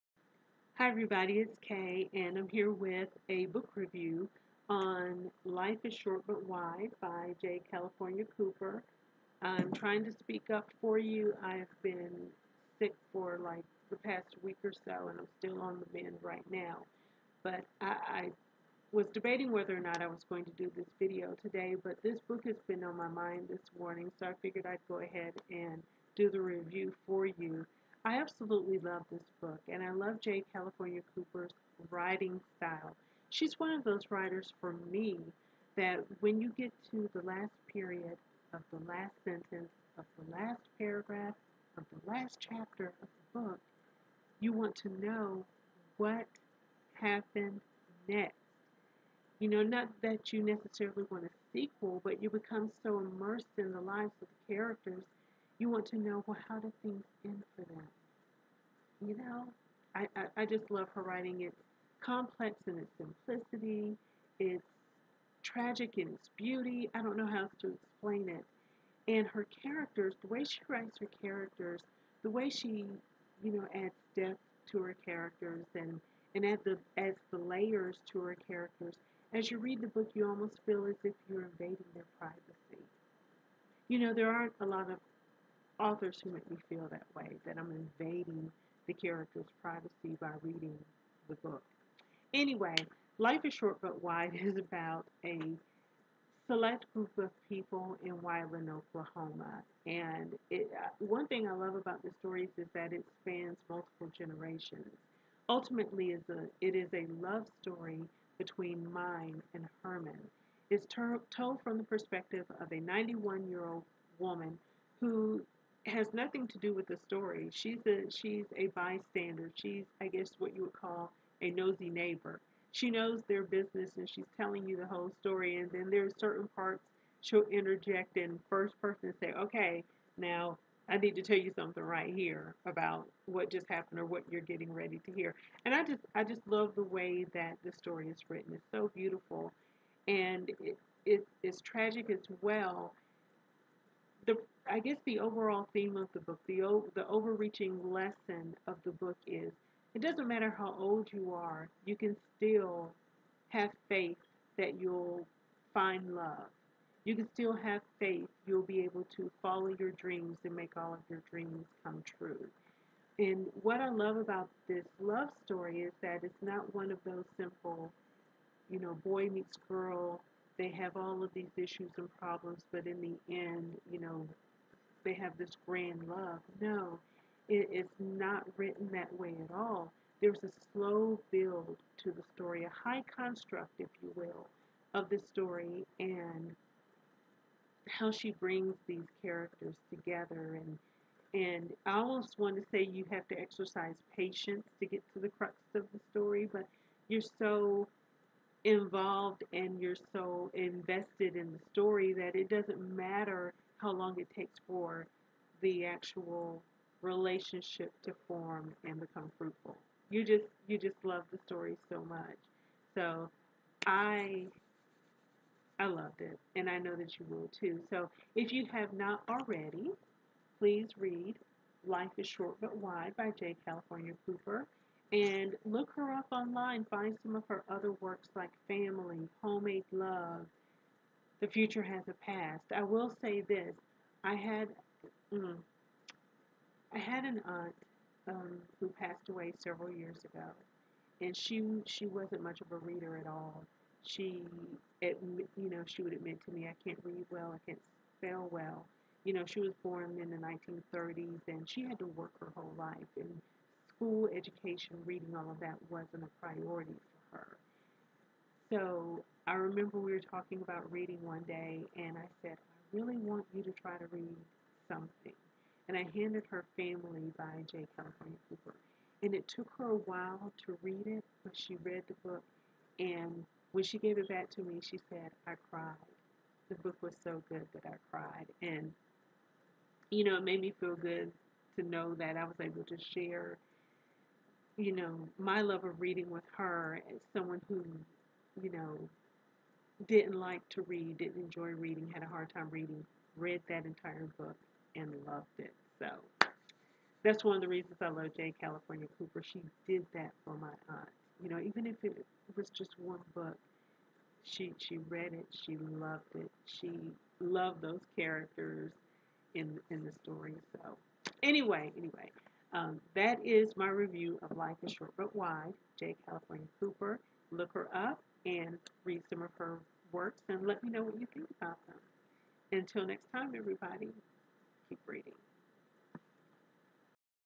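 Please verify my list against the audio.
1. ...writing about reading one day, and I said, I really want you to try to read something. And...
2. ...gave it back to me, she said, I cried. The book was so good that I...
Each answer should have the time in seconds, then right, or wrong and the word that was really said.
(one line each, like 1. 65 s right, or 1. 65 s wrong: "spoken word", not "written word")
1. 260 s wrong: "talking", not "writing"
2. 273 s right.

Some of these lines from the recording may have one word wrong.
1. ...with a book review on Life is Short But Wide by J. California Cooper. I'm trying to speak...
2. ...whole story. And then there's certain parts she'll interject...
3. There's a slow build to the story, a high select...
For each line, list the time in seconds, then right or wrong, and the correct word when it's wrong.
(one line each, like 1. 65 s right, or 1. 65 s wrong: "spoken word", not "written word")
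1. 2 s right
2. 124 s right
3. 180 s wrong: "construct", not "select".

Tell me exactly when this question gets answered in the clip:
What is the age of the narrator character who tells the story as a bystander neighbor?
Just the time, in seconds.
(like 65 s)
112 s.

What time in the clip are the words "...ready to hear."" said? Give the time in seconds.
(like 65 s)
134 s.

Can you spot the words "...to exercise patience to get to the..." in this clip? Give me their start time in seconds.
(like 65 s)
193 s.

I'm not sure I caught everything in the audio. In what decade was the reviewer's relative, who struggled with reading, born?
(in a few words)
1930s.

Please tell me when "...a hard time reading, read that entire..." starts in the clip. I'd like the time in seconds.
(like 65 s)
292 s.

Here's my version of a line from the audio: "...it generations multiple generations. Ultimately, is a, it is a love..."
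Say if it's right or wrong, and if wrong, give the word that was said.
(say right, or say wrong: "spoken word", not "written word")
wrong: "spans", not "generations".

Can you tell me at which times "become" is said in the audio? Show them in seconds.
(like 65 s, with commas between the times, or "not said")
52 s, 208 s.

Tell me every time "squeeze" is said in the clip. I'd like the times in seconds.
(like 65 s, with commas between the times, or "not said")
not said.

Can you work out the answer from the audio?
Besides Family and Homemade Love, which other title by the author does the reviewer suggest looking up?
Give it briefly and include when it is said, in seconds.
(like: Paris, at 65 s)
The Future Has a Past, at 231 s.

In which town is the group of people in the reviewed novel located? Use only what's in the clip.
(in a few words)
Wyandotte, Oklahoma.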